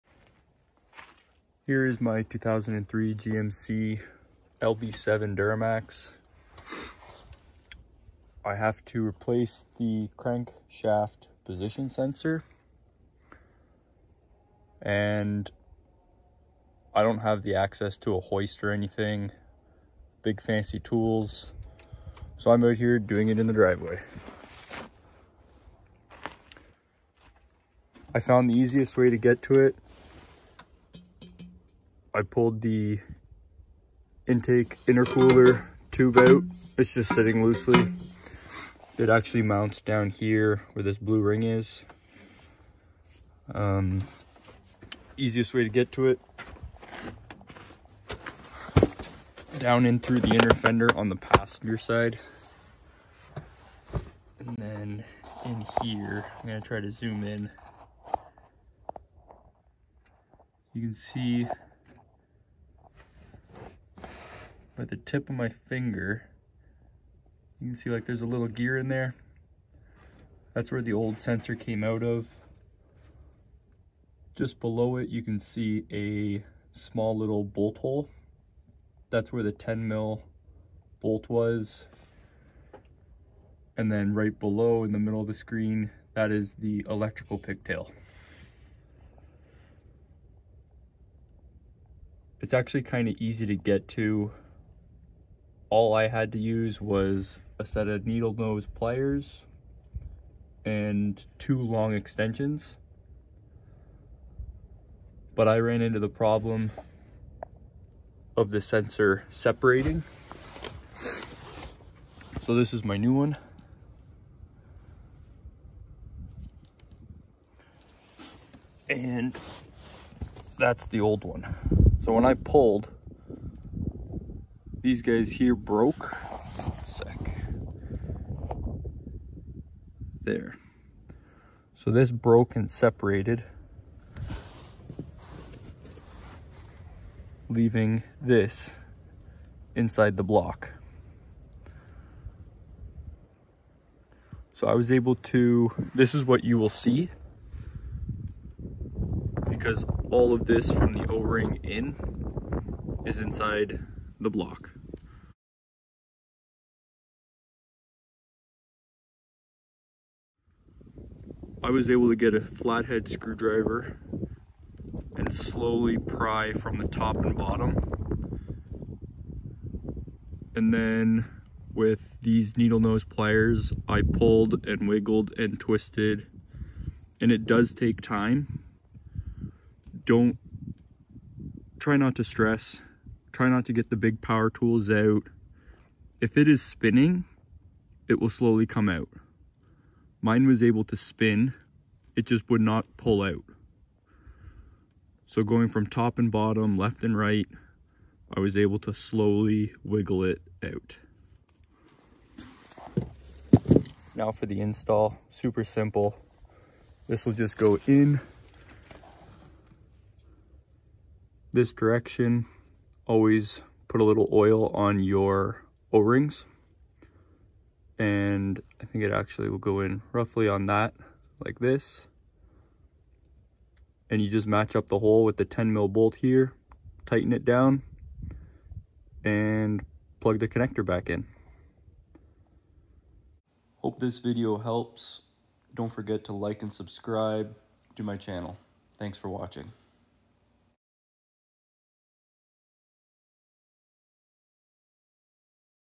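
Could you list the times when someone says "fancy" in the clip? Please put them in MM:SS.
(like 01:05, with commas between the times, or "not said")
00:20.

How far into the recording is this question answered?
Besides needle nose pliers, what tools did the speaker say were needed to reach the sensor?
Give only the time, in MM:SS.
01:41.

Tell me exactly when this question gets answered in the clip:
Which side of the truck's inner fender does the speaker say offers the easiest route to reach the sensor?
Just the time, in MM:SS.
00:51.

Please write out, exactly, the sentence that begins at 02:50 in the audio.
And then with these needle nose pliers, I pulled and wiggled and twisted.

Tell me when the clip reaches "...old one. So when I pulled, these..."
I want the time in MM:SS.
02:00.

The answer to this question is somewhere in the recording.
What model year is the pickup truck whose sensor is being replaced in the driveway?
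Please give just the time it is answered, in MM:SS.
00:02.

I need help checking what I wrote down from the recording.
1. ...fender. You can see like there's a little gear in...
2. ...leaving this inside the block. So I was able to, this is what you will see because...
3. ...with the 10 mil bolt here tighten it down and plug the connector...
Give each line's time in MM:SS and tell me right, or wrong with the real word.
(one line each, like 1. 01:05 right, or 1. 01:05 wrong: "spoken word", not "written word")
1. 01:05 wrong: "finger", not "fender"
2. 02:17 right
3. 03:45 right.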